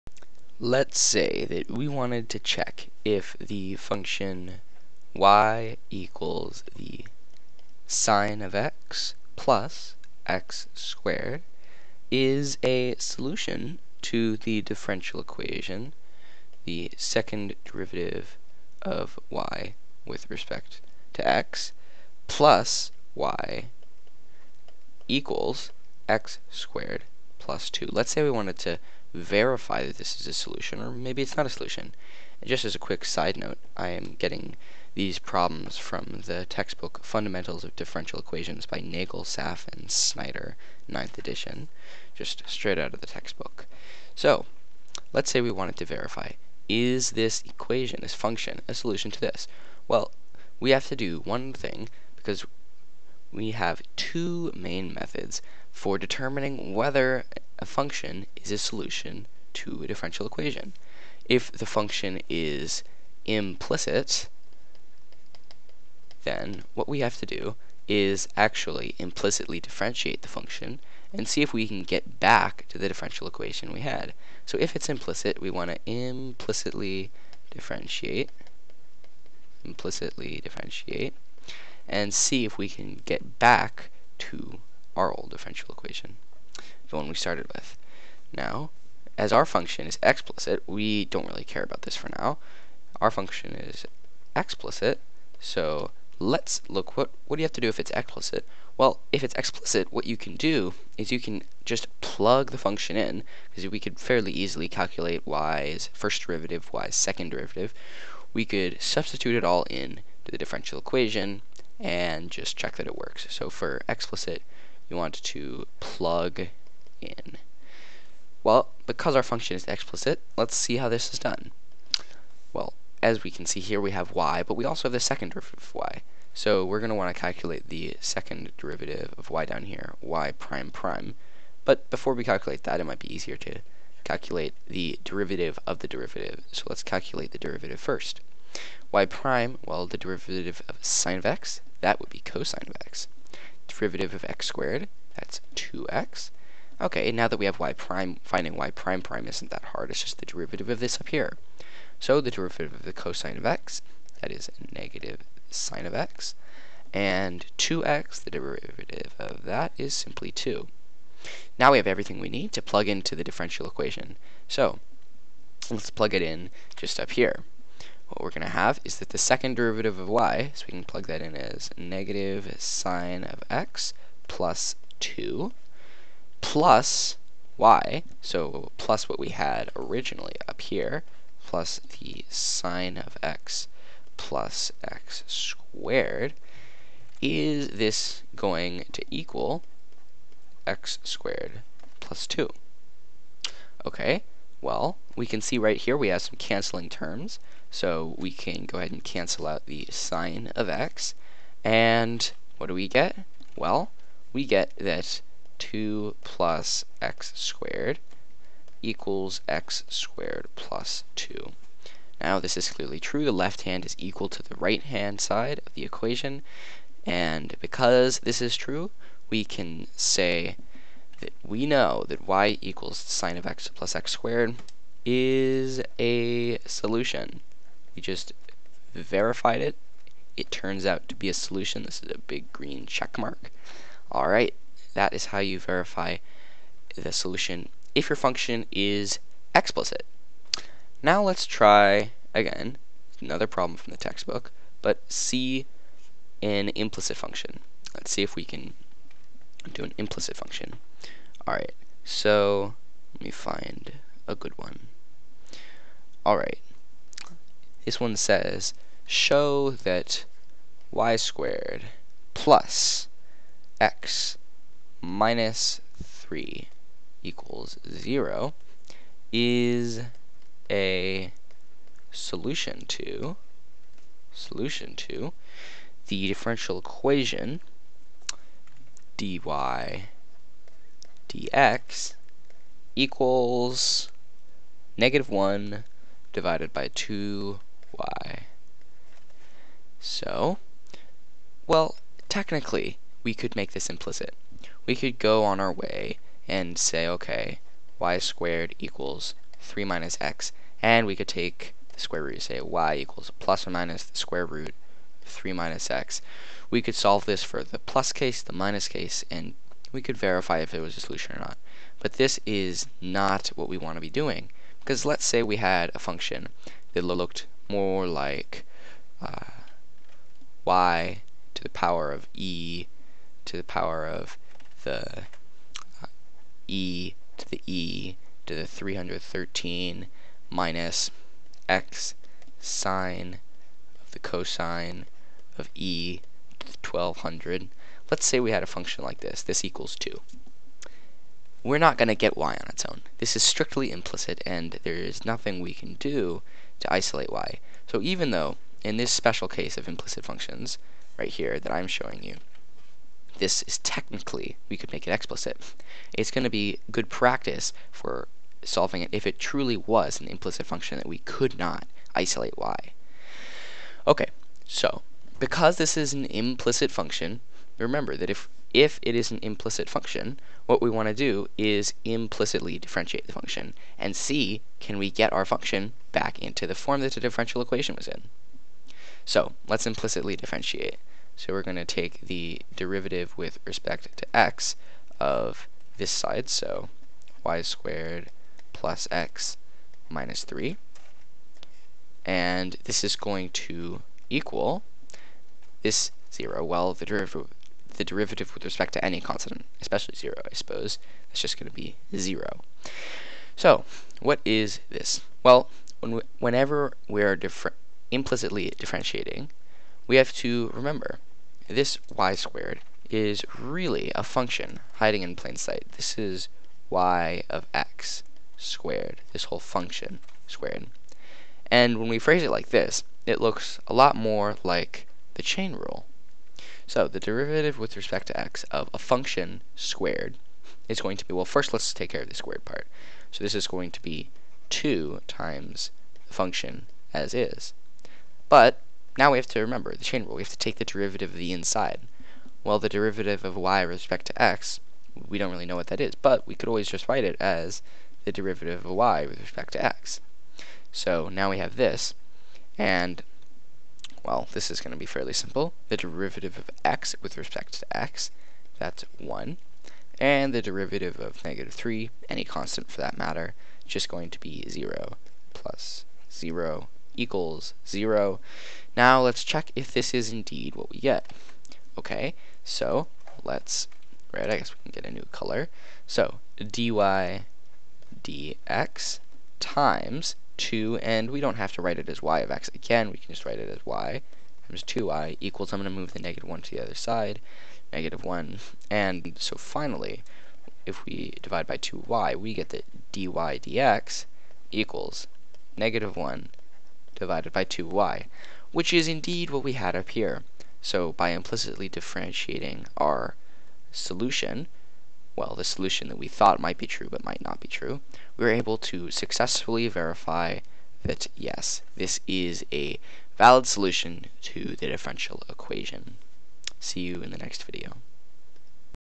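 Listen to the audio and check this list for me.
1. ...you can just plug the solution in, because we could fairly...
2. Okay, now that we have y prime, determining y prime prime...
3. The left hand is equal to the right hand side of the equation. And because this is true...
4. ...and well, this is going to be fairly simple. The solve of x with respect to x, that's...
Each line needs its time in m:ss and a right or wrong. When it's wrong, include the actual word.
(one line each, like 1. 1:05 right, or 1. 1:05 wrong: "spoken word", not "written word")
1. 1:41 wrong: "function", not "solution"
2. 2:26 wrong: "finding", not "determining"
3. 3:33 right
4. 7:32 wrong: "derivative", not "solve".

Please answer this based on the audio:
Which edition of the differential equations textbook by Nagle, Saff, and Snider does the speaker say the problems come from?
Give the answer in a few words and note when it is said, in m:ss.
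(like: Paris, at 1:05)
9th edition, at 0:40.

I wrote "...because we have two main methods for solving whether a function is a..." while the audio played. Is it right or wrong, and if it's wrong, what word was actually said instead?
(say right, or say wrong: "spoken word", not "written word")
wrong: "determining", not "solving".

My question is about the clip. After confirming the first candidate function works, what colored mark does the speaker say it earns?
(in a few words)
big green check mark.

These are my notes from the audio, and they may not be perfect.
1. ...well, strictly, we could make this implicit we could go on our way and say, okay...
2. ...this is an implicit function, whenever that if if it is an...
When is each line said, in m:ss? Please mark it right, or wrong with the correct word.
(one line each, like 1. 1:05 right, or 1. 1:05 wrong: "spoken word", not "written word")
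1. 4:51 wrong: "technically", not "strictly"
2. 6:05 wrong: "remember", not "whenever".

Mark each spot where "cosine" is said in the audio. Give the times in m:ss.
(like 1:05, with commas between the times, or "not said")
2:22, 2:32, 5:34.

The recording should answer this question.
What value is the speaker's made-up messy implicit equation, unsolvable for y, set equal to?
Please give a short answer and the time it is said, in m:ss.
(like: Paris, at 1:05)
2, at 5:39.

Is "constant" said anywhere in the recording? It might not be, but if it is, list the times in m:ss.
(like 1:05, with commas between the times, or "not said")
6:39, 7:42.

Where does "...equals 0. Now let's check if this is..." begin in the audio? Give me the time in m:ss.
7:47.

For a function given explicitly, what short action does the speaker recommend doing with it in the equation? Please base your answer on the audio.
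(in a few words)
plug in.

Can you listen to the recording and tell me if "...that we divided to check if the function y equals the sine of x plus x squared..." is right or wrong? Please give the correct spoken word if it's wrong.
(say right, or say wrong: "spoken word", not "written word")
wrong: "wanted", not "divided".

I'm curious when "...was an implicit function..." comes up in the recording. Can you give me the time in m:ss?
5:59.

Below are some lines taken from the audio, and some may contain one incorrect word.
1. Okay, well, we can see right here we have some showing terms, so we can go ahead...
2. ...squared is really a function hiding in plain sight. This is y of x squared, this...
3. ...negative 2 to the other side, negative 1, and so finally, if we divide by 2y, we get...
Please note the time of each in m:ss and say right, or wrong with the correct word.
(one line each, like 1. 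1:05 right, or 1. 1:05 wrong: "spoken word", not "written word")
1. 3:13 wrong: "canceling", not "showing"
2. 6:52 right
3. 8:06 wrong: "1", not "2".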